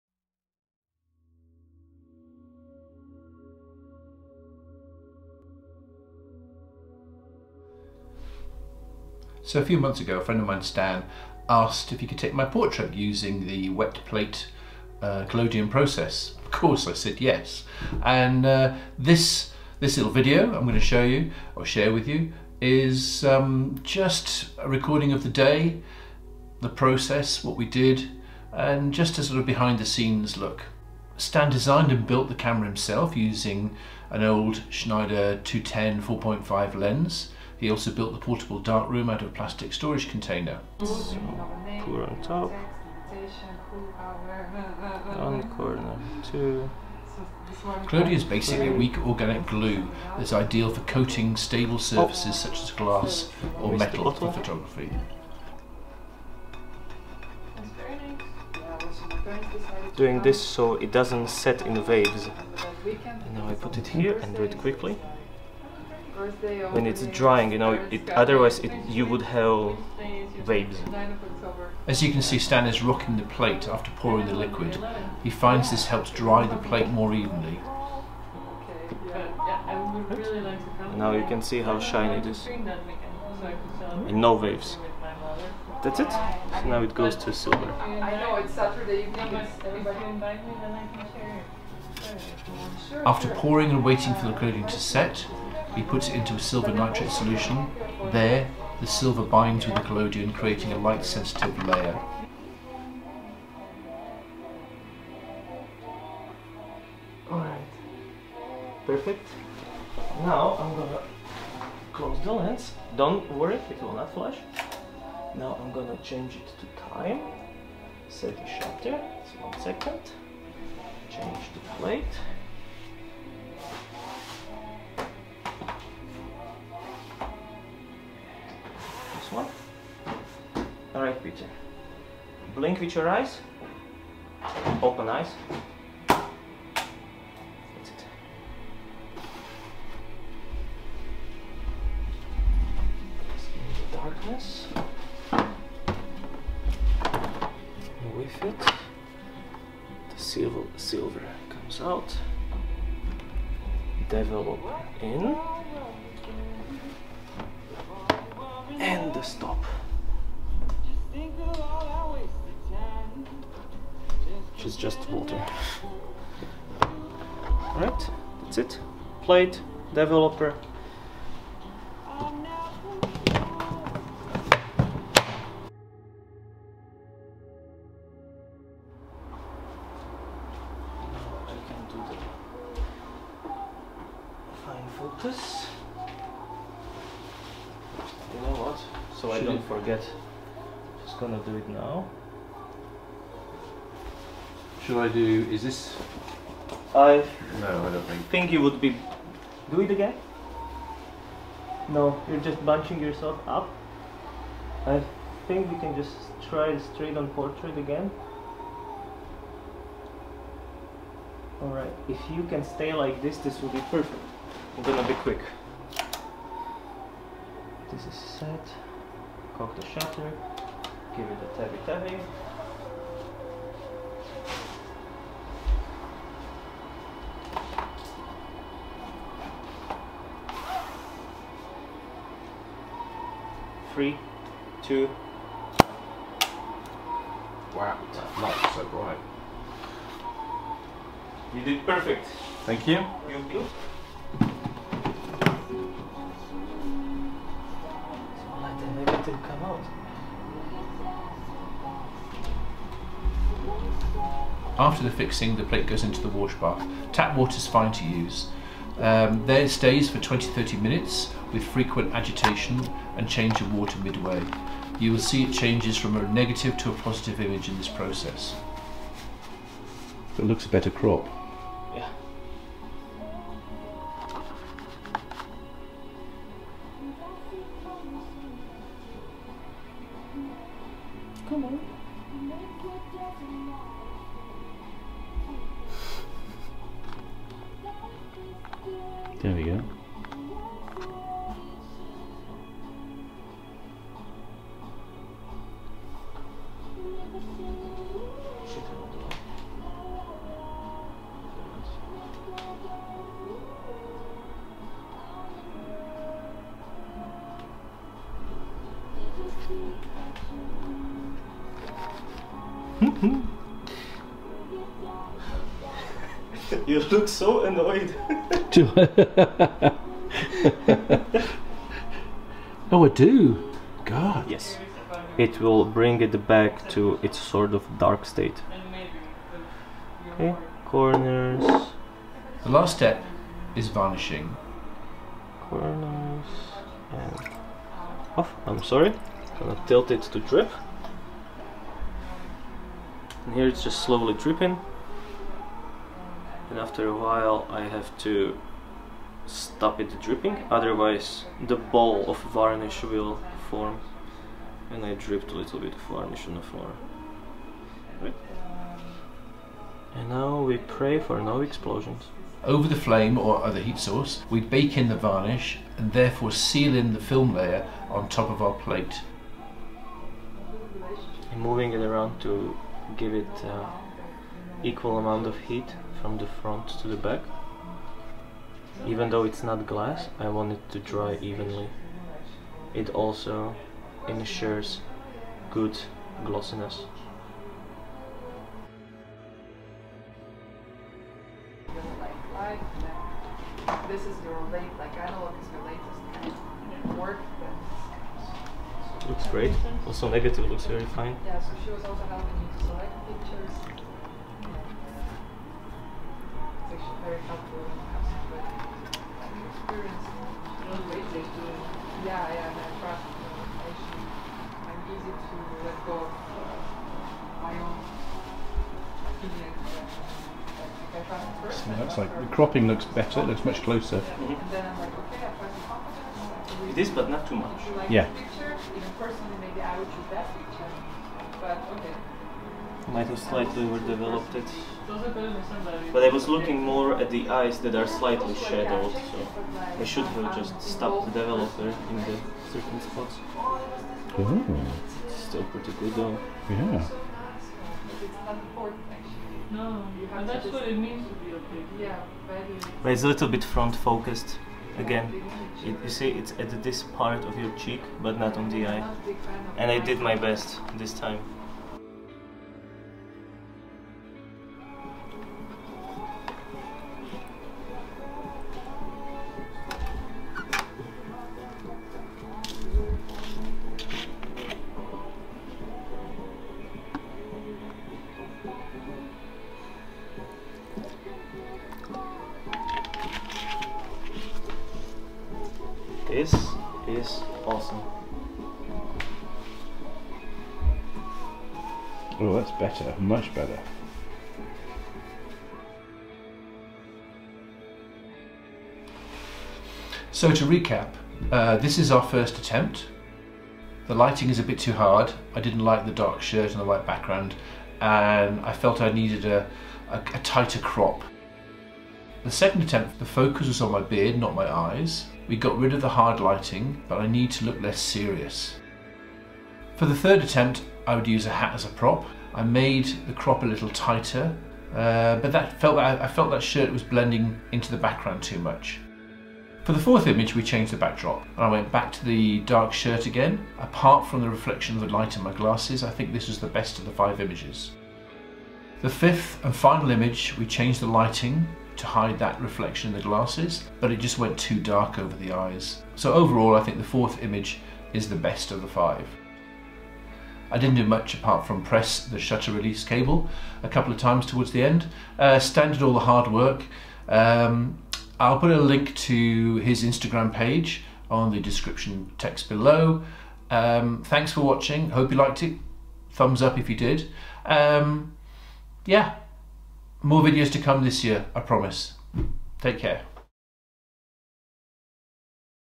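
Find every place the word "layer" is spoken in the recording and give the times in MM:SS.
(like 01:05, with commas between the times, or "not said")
01:41, 06:07.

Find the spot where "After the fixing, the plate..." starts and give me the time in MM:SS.
04:14.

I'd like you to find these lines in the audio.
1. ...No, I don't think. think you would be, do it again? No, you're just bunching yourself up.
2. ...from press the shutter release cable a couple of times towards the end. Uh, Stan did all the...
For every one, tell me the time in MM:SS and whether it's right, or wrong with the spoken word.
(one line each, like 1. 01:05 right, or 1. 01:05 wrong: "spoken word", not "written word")
1. 03:17 right
2. 09:11 right.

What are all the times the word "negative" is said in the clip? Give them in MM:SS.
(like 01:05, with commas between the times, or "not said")
04:26, 06:40.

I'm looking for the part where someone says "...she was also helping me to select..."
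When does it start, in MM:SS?
06:41.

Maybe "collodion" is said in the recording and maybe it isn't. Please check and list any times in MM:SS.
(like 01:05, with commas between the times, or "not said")
00:15, 00:47, 01:39.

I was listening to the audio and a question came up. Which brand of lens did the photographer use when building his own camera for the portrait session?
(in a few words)
Schneider.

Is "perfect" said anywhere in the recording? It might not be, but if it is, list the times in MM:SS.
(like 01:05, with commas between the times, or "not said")
01:48, 03:33, 04:01.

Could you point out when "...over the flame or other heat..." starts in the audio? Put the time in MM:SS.
06:02.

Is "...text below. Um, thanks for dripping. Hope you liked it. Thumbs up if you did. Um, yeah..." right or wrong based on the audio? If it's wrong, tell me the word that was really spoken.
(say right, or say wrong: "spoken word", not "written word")
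wrong: "watching", not "dripping".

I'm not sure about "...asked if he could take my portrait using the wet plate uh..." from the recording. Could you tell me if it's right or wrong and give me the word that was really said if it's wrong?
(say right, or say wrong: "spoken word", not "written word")
right.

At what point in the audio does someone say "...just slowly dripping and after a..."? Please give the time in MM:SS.
05:43.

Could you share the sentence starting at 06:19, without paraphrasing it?
Even though it's not glass, I want it to dry evenly.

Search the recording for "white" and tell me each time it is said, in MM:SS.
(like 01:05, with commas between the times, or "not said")
08:26.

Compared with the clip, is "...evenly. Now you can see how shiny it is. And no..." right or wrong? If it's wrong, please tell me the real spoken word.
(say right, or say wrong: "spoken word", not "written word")
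right.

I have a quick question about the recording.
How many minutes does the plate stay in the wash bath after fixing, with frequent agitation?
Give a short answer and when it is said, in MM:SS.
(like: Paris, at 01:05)
20-30 minutes, at 04:20.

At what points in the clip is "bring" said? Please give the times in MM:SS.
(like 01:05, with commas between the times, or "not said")
05:25.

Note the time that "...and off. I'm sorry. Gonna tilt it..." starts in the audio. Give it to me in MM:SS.
05:37.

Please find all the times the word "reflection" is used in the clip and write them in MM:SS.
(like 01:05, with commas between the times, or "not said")
08:54, 09:02.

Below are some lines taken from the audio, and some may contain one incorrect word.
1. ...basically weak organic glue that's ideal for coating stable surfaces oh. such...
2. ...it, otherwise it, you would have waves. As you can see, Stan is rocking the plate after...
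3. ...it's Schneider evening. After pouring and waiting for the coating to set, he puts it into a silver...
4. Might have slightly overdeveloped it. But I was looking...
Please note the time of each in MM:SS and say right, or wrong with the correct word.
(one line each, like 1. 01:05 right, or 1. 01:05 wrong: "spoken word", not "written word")
1. 00:48 right
2. 01:07 right
3. 01:28 wrong: "Saturday", not "Schneider"
4. 07:13 right.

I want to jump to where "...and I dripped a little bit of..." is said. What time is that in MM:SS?
05:54.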